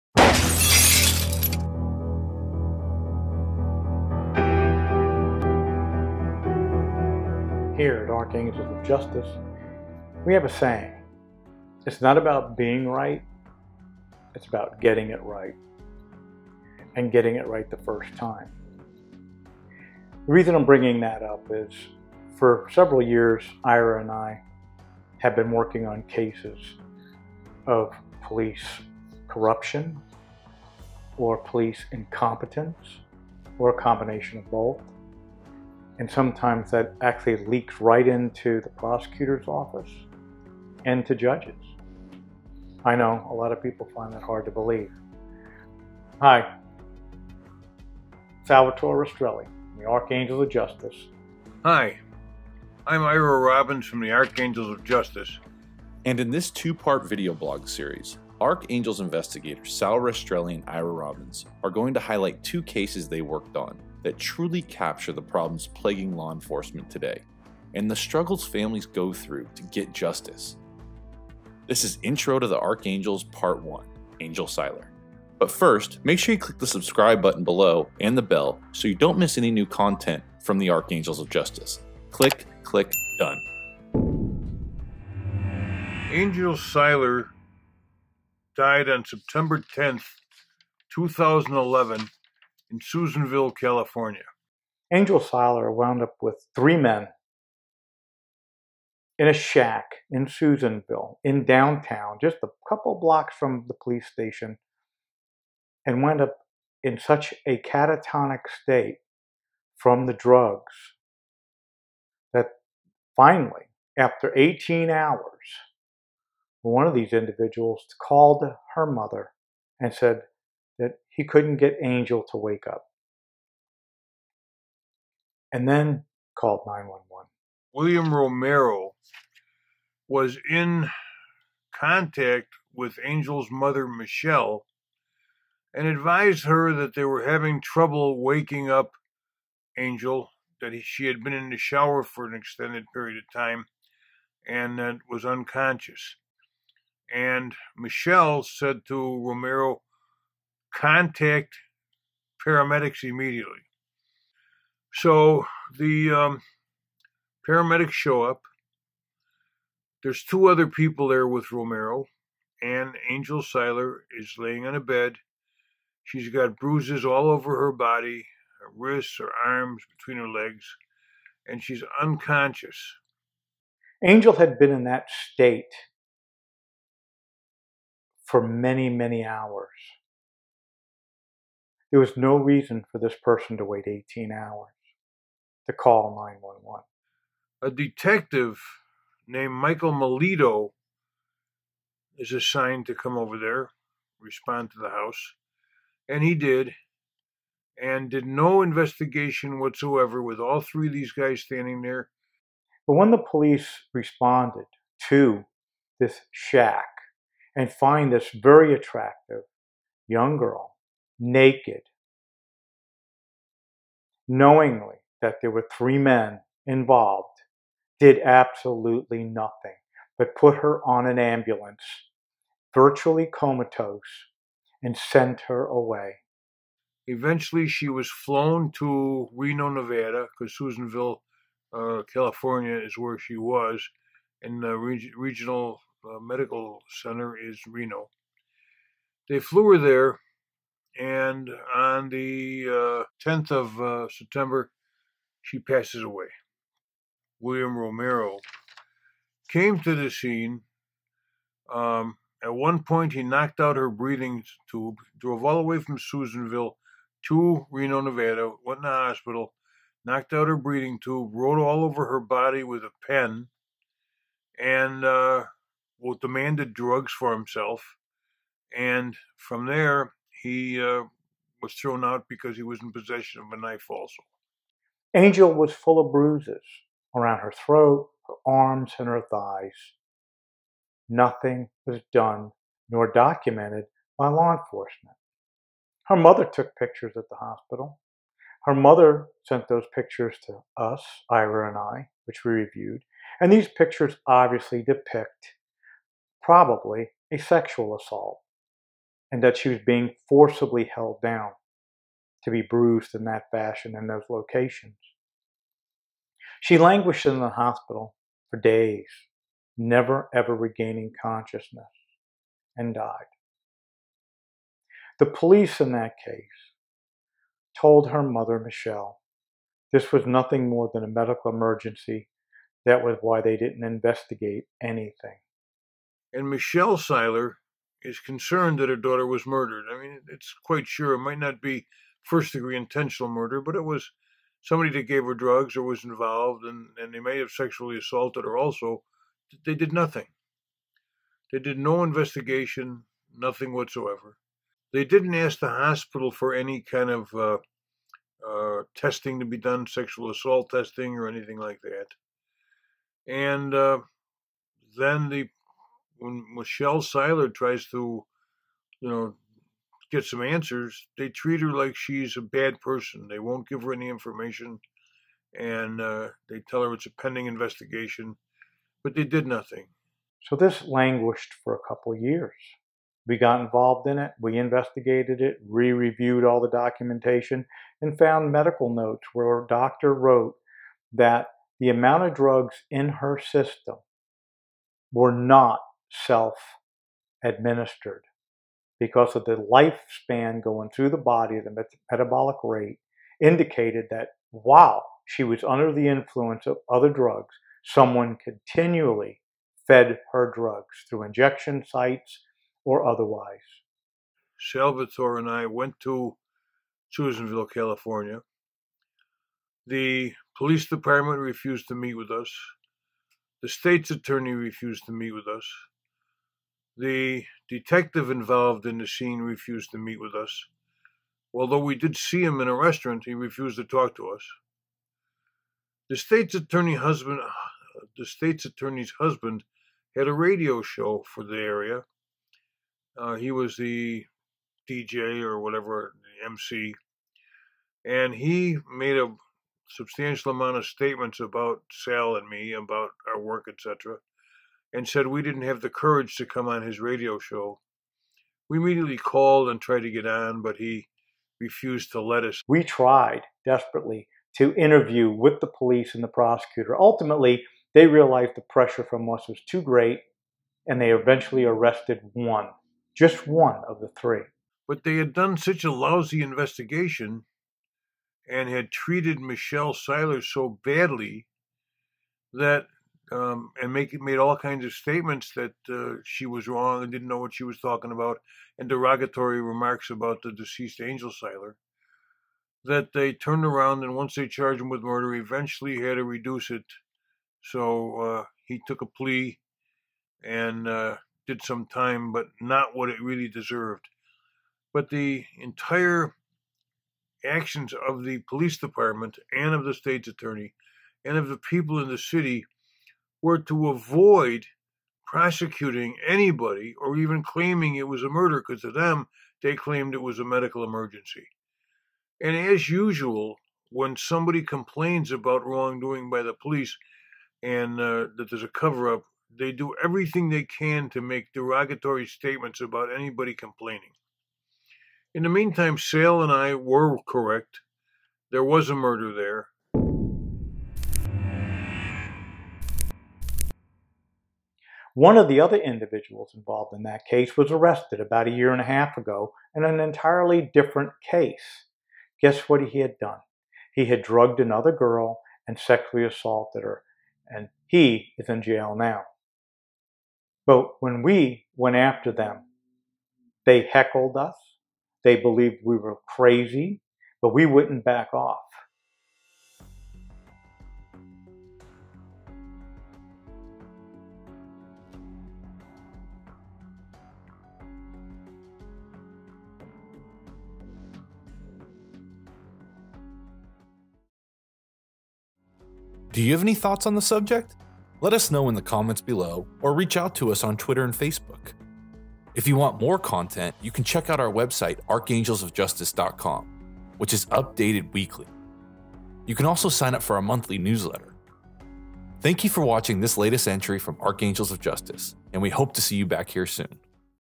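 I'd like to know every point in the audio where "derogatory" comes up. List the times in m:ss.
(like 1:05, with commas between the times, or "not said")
7:58, 8:41.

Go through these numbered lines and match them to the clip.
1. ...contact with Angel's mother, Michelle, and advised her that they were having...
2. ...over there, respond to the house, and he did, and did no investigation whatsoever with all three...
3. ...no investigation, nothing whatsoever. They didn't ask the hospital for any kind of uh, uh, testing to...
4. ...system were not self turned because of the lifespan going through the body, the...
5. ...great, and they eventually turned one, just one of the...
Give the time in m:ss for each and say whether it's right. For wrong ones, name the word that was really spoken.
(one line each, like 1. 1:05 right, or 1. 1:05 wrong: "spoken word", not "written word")
1. 2:11 right
2. 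3:13 right
3. 5:41 right
4. 6:23 wrong: "administered", not "turned"
5. 7:39 wrong: "arrested", not "turned".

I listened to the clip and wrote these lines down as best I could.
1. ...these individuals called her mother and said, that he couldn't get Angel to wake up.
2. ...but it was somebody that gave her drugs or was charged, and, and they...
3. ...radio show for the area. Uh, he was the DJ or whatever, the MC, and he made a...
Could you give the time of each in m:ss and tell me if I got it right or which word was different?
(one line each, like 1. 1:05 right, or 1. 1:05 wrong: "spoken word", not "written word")
1. 1:56 right
2. 5:33 wrong: "involved", not "charged"
3. 7:10 right.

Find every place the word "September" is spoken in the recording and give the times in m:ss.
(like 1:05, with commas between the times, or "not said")
1:29, 4:04.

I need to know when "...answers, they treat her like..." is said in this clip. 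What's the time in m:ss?
6:00.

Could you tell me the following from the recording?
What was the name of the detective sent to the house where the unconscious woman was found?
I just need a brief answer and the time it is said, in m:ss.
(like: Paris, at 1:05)
Michael Melito, at 3:09.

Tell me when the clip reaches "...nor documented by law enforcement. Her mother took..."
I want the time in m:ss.
4:42.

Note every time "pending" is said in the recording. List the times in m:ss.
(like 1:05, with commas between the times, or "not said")
6:07.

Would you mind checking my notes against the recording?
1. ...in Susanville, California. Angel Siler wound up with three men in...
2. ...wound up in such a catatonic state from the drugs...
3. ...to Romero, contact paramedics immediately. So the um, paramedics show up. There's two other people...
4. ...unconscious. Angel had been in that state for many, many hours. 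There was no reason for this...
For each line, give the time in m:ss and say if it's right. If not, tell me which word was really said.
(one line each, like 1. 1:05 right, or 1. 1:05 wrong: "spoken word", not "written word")
1. 1:32 right
2. 1:46 right
3. 2:28 right
4. 2:52 right.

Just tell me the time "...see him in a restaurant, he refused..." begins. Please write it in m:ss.
7:02.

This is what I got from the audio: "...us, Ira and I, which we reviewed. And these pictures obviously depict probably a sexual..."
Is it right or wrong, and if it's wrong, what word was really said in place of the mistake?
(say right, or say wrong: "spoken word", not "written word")
right.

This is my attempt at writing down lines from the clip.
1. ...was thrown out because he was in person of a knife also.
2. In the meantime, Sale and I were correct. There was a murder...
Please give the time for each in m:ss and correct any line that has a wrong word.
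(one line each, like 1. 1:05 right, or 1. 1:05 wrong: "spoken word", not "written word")
1. 4:31 wrong: "possession", not "person"
2. 8:45 right.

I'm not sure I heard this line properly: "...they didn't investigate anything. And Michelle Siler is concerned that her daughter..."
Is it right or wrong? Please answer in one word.
right.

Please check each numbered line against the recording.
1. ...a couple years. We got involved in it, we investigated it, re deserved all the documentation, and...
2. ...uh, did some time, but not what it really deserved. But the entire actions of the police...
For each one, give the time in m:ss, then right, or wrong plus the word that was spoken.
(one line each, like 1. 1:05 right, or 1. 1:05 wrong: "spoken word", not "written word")
1. 6:11 wrong: "reviewed", not "deserved"
2. 8:10 right.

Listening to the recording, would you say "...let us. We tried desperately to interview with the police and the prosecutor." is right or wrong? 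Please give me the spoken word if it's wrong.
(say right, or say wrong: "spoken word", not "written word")
right.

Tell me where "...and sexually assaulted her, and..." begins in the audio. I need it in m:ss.
9:05.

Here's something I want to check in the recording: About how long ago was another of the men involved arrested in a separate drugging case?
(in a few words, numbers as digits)
a year and a half.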